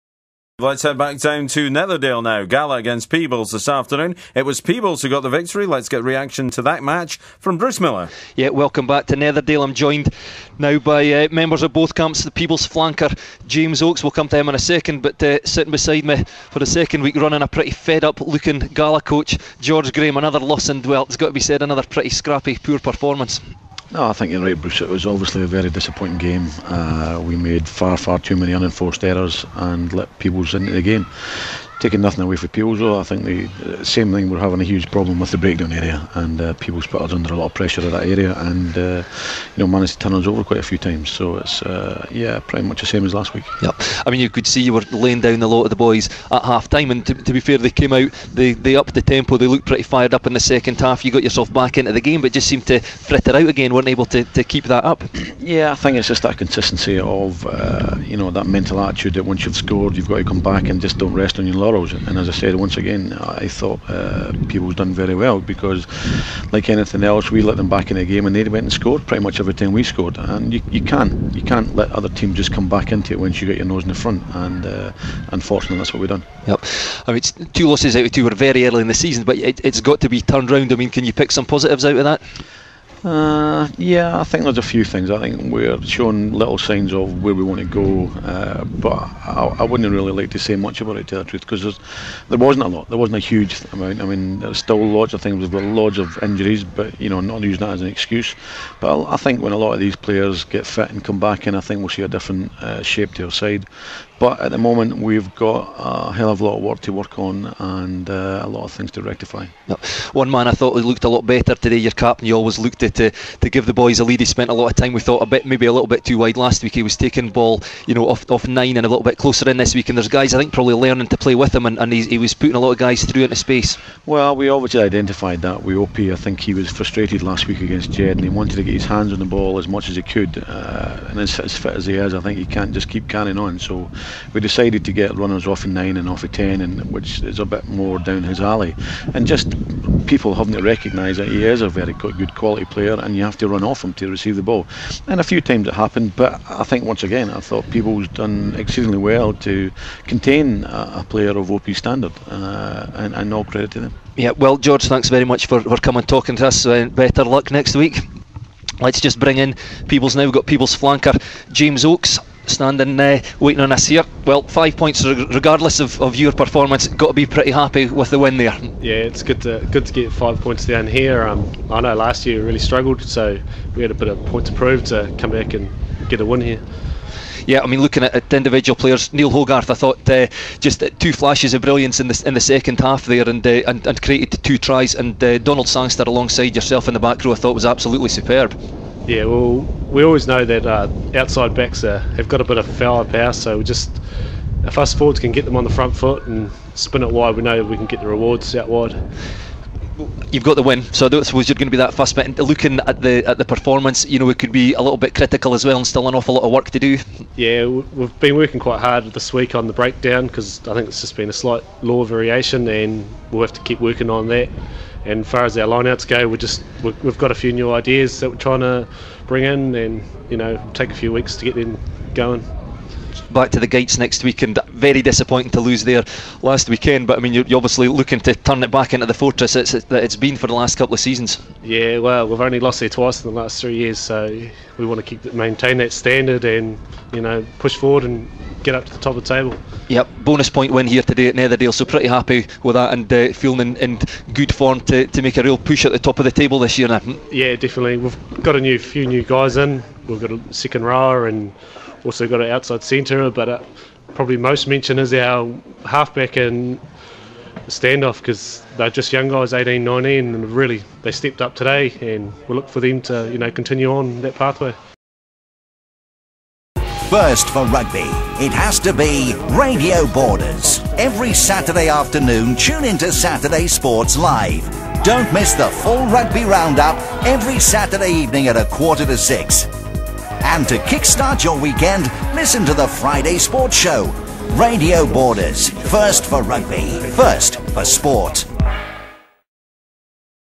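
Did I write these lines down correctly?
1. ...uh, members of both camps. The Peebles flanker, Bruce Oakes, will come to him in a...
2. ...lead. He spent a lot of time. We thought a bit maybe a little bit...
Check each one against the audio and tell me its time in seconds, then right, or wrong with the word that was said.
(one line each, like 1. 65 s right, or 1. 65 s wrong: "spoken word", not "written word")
1. 11 s wrong: "James", not "Bruce"
2. 114 s right.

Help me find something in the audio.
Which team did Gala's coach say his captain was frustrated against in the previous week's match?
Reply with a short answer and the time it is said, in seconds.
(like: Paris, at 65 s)
Jed, at 127 s.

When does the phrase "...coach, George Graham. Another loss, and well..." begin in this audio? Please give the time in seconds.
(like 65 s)
19 s.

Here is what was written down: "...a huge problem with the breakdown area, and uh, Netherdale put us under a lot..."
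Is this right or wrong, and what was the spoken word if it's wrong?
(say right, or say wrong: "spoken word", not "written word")
wrong: "Peebles", not "Netherdale".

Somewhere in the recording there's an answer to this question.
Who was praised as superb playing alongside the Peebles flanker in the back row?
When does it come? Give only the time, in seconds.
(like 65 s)
185 s.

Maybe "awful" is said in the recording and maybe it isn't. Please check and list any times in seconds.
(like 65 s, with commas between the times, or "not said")
206 s.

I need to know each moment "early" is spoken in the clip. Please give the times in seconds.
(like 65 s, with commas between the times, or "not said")
78 s.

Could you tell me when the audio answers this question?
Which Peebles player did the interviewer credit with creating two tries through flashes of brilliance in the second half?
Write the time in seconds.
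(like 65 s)
179 s.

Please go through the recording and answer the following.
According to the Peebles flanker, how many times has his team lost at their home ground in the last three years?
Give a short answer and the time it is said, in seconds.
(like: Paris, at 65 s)
2, at 232 s.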